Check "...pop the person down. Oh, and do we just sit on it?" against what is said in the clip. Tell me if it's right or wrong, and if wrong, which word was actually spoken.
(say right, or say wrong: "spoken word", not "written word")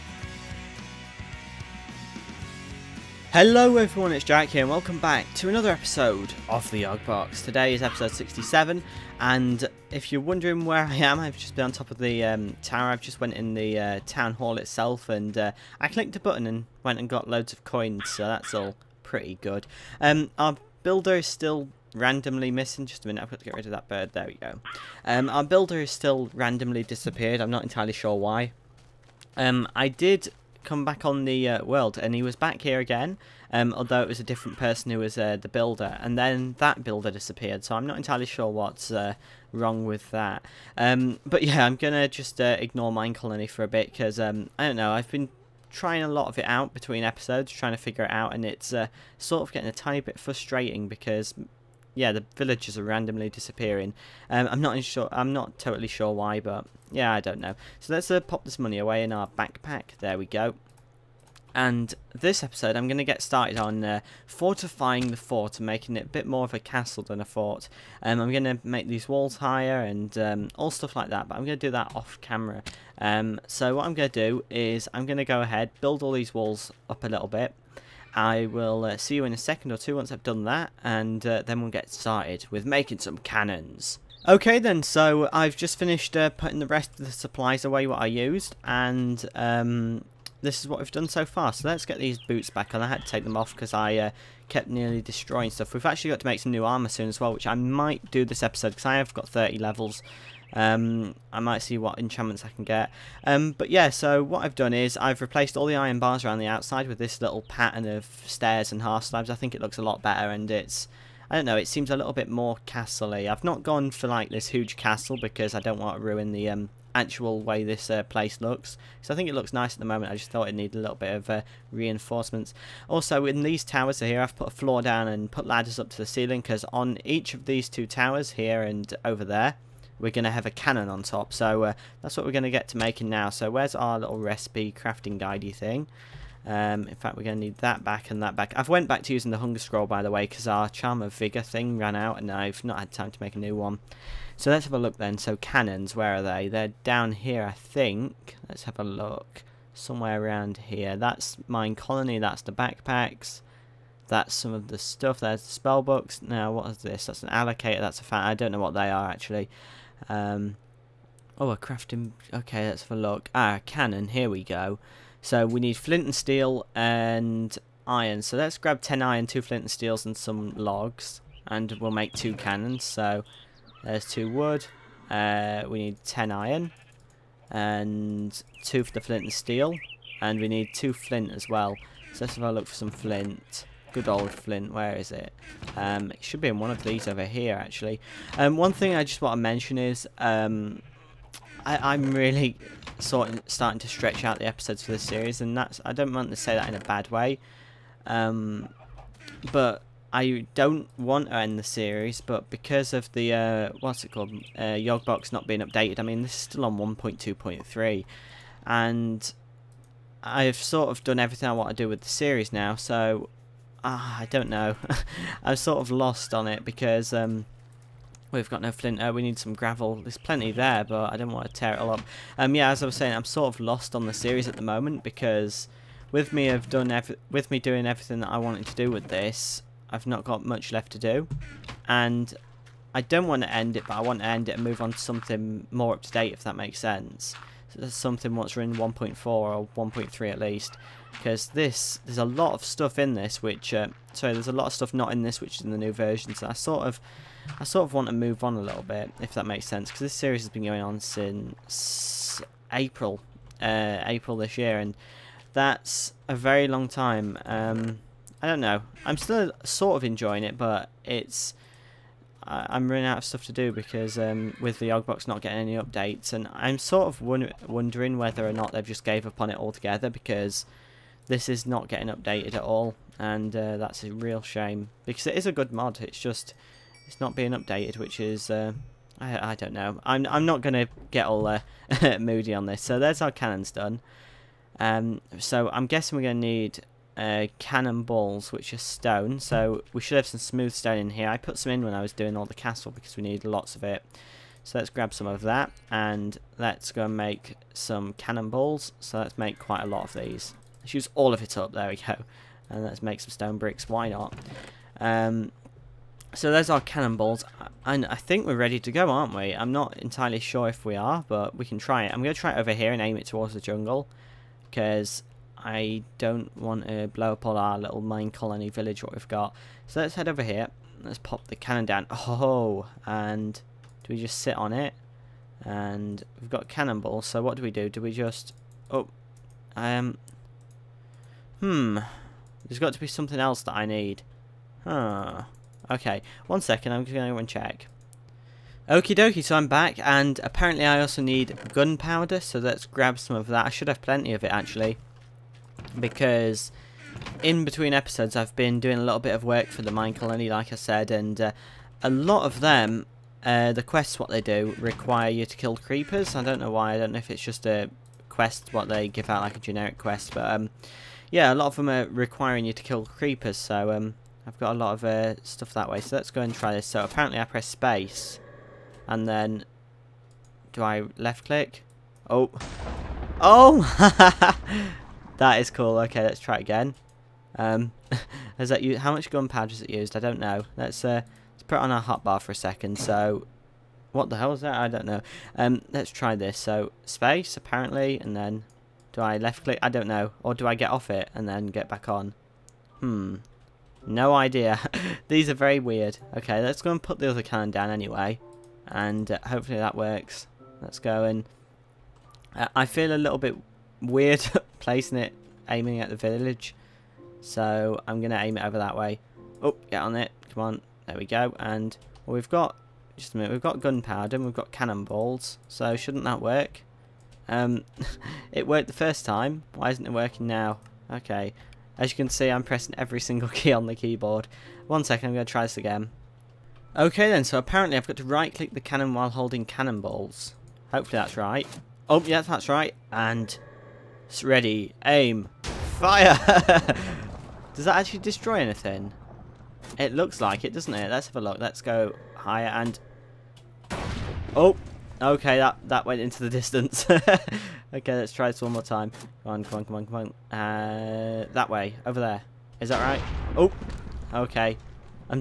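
wrong: "cannon", not "person".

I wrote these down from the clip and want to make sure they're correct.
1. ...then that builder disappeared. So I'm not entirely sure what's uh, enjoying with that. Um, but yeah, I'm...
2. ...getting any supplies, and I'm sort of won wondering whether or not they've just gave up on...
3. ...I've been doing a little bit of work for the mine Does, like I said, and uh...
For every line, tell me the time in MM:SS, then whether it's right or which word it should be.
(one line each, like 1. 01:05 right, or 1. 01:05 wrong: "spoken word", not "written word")
1. 00:36 wrong: "wrong", not "enjoying"
2. 04:25 wrong: "updates", not "supplies"
3. 05:48 wrong: "Colony", not "Does".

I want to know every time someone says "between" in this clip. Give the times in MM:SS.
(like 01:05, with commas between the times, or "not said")
00:46, 05:47.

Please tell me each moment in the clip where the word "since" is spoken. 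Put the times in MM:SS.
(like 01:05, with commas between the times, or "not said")
04:10.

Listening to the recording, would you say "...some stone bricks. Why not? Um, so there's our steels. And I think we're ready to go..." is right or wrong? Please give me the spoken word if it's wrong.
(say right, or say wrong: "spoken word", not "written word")
wrong: "cannonballs", not "steels".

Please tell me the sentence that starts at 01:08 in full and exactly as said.
Um, I'm going to make these walls higher and um, all stuff like that, but I'm going to do that off camera.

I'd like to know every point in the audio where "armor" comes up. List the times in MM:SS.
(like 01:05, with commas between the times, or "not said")
01:36.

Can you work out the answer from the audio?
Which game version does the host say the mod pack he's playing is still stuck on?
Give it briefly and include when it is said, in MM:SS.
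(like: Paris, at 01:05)
1.2.3, at 03:26.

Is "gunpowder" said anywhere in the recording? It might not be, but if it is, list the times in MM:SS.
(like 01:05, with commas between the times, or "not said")
05:41, 06:19, 06:53.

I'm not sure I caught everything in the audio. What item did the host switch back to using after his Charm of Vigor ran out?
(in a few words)
Hunger Scroll.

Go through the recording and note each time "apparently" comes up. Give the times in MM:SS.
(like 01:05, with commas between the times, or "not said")
05:40, 06:07, 06:27, 07:07.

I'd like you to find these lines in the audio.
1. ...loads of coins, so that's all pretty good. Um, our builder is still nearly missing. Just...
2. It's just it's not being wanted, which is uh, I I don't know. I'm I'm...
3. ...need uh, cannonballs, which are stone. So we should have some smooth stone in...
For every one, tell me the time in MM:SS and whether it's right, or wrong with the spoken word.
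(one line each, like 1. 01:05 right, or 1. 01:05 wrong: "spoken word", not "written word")
1. 00:17 wrong: "randomly", not "nearly"
2. 04:35 wrong: "updated", not "wanted"
3. 04:46 right.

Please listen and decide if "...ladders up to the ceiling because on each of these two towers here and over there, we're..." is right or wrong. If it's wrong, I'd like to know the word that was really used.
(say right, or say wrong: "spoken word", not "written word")
right.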